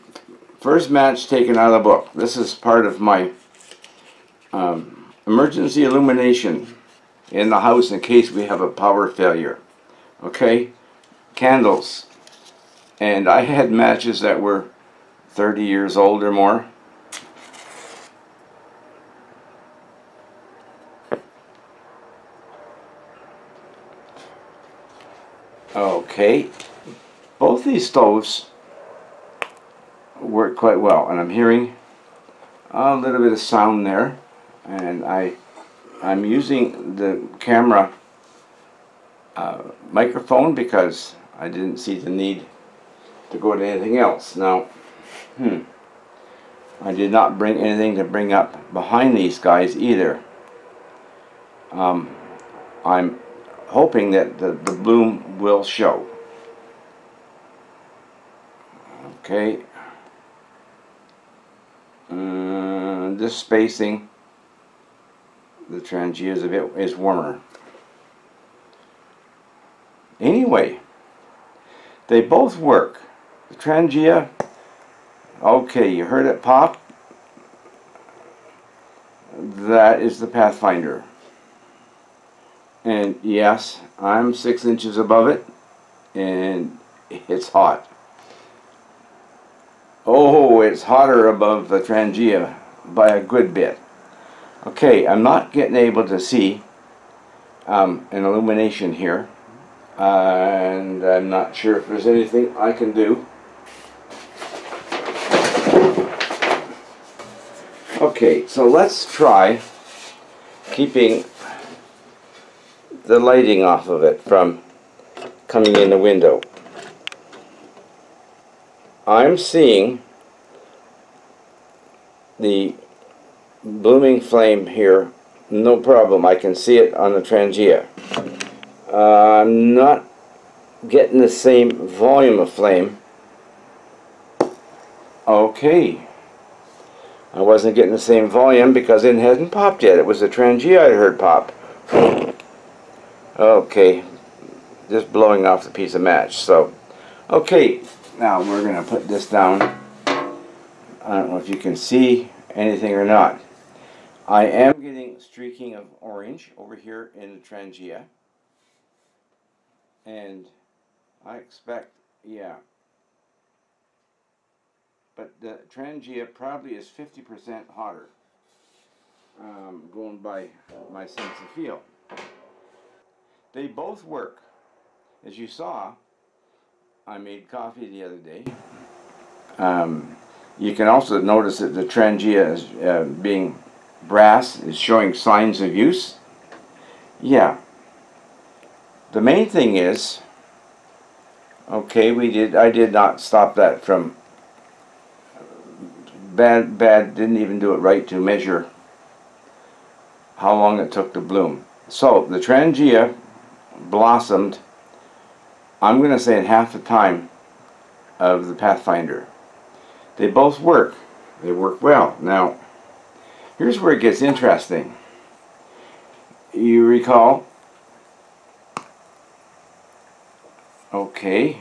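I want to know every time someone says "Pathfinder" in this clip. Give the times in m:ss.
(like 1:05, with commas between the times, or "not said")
1:20, 3:28.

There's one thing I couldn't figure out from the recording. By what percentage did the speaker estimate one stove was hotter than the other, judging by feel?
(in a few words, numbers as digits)
50%.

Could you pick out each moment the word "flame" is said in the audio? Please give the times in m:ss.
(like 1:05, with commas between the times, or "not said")
2:04, 2:12.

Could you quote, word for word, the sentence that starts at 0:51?
Um, I'm hoping that the, the bloom will show.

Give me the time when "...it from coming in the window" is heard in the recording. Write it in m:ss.
1:54.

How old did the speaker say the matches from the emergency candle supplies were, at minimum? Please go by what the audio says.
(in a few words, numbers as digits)
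30 years.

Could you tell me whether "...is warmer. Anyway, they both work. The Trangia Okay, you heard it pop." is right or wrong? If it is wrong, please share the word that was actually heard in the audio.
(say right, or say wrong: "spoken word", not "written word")
right.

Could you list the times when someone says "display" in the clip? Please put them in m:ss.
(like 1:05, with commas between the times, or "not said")
not said.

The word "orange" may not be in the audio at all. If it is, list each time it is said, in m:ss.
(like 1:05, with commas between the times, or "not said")
2:36.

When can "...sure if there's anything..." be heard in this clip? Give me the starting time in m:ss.
1:41.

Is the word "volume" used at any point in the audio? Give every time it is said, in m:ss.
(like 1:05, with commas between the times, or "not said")
2:11, 2:18.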